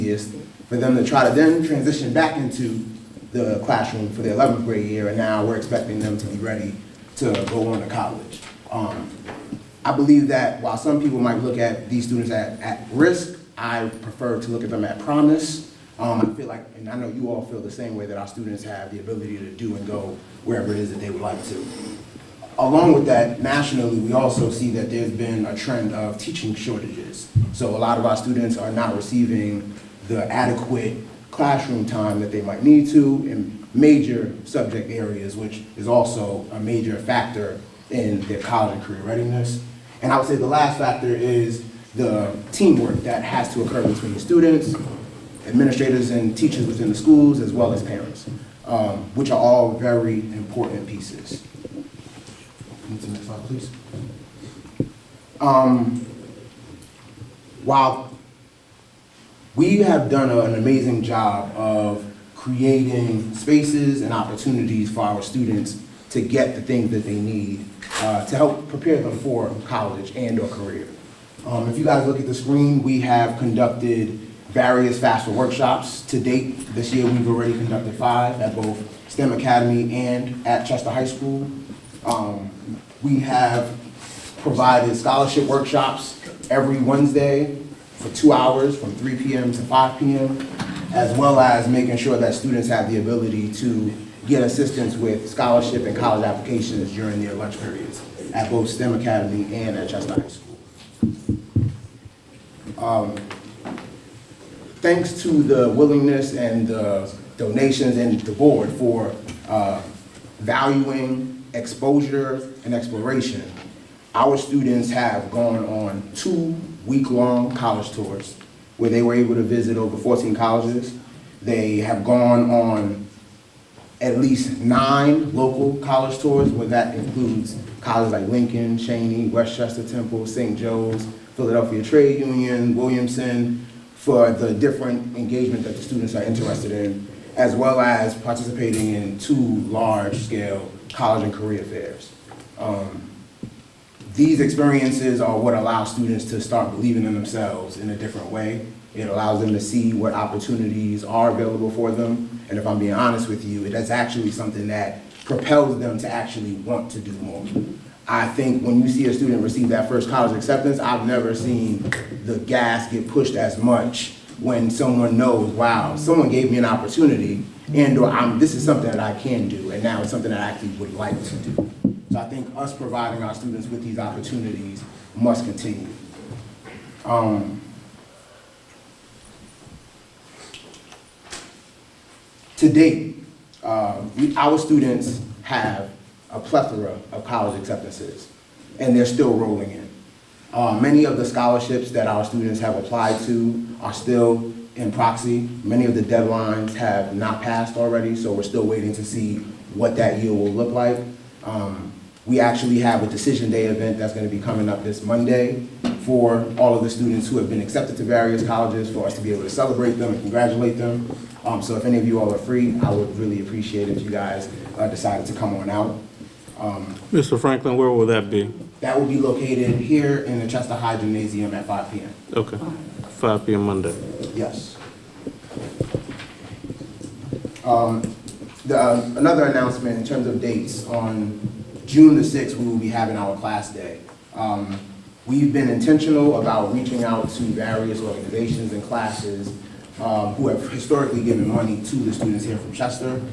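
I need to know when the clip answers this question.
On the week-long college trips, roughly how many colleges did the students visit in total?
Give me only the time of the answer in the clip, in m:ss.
1:59.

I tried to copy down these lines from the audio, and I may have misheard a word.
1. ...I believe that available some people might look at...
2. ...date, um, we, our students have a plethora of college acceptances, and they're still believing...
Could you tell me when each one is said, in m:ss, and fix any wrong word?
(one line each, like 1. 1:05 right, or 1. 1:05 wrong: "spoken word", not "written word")
1. 0:09 wrong: "while", not "available"
2. 3:02 wrong: "rolling", not "believing".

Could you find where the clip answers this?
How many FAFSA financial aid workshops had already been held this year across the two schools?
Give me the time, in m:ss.
1:17.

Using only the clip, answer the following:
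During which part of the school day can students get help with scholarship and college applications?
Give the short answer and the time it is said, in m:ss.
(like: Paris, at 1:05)
lunch periods, at 1:37.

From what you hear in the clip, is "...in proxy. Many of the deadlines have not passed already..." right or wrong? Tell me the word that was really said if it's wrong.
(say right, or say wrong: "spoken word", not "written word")
right.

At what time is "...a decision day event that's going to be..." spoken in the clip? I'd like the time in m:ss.
3:23.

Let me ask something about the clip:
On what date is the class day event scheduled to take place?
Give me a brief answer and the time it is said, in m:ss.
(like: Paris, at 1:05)
June 6, at 3:51.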